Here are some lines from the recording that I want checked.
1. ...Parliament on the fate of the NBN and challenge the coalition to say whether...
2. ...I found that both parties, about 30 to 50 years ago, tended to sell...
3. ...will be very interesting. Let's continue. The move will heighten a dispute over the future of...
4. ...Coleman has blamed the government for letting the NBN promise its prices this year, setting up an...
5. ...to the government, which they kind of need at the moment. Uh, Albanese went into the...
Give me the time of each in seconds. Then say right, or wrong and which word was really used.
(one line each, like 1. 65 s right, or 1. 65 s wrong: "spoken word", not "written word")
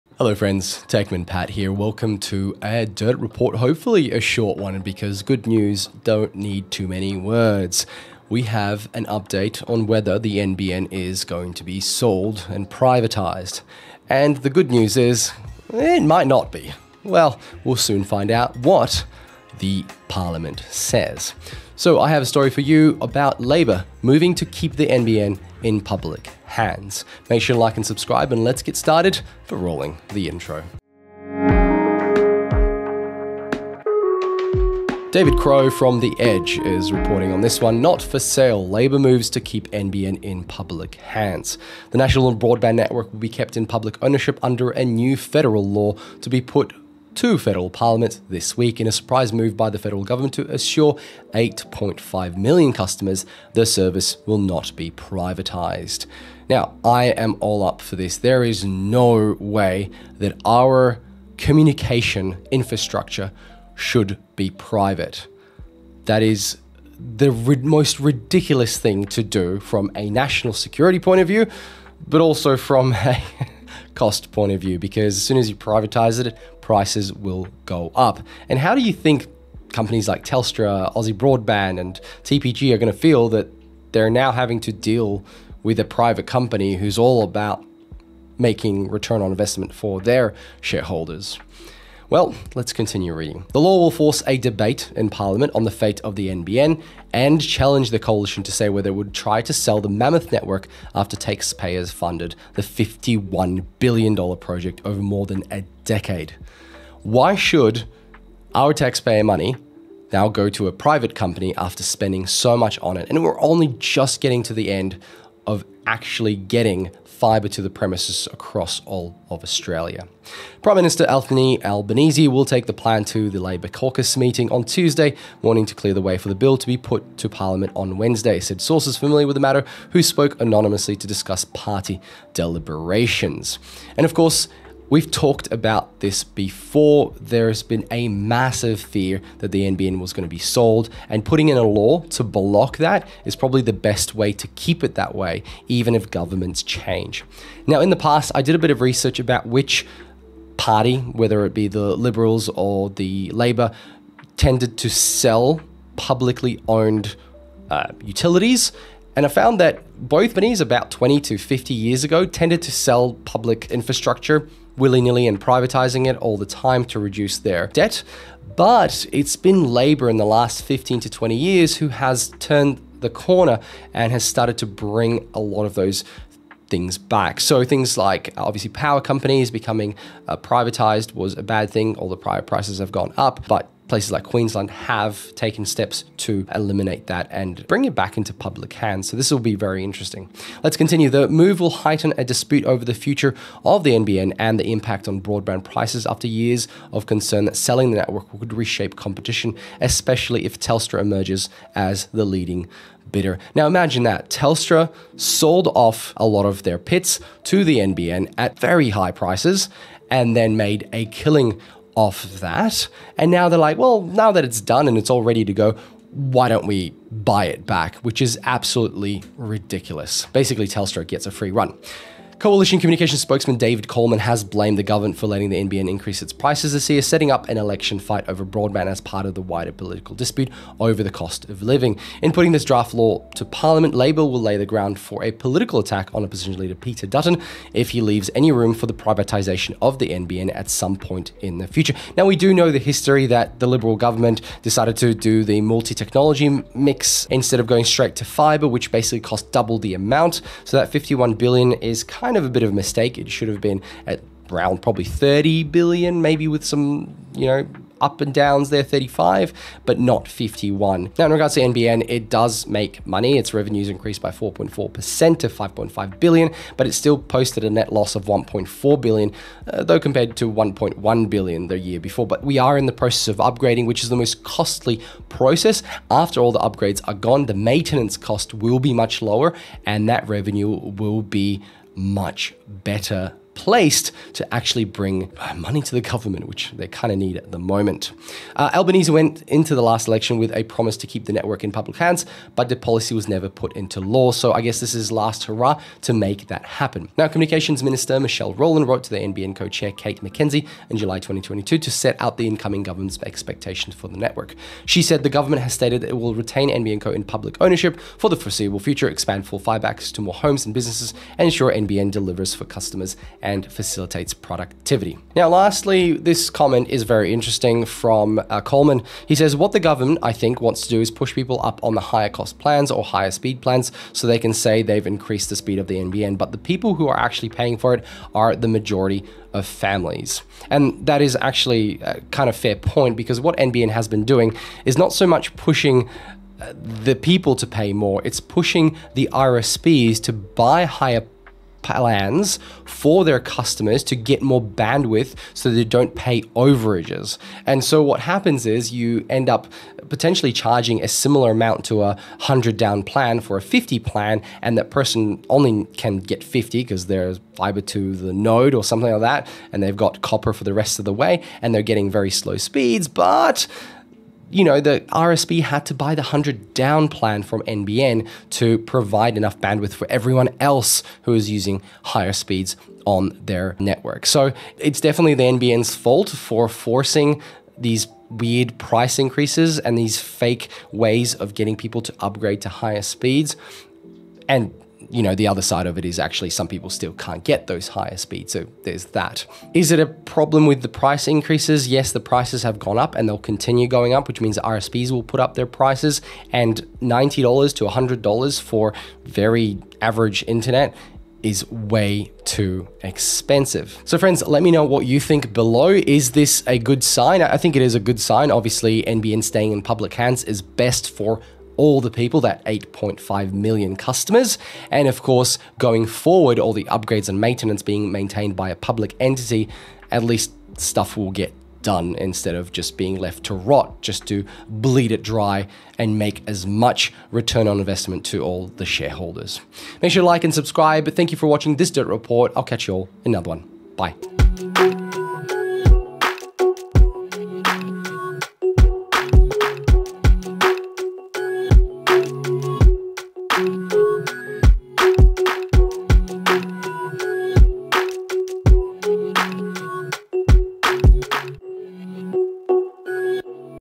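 1. 95 s right
2. 159 s wrong: "20", not "30"
3. 189 s right
4. 223 s wrong: "increase", not "promise"
5. 285 s right.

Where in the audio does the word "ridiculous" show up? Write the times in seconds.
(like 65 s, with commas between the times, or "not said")
68 s, 219 s.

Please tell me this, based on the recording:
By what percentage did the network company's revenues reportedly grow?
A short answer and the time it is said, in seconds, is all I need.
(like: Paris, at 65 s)
4.4%, at 264 s.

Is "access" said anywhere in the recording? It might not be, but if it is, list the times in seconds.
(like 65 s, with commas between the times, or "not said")
309 s.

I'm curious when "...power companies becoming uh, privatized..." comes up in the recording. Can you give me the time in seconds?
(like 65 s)
178 s.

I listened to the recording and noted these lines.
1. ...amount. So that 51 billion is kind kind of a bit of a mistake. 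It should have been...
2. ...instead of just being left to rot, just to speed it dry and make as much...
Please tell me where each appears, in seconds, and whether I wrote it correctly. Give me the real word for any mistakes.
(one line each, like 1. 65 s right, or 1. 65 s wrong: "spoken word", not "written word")
1. 249 s right
2. 422 s wrong: "bleed", not "speed".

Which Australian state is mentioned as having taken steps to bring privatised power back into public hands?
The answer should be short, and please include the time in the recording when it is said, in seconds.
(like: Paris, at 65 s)
Queensland, at 184 s.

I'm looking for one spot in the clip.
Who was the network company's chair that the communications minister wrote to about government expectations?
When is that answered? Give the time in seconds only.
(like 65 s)
299 s.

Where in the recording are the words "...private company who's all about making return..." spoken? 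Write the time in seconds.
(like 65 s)
85 s.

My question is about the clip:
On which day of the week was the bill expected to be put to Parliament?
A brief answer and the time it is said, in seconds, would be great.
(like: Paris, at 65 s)
Wednesday, at 127 s.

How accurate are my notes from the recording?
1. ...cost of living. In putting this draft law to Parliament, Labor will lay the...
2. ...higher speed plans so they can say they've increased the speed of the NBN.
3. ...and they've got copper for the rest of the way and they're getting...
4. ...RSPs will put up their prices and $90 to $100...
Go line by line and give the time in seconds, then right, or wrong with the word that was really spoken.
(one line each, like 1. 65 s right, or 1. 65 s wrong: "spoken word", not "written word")
1. 231 s right
2. 323 s right
3. 359 s right
4. 394 s right.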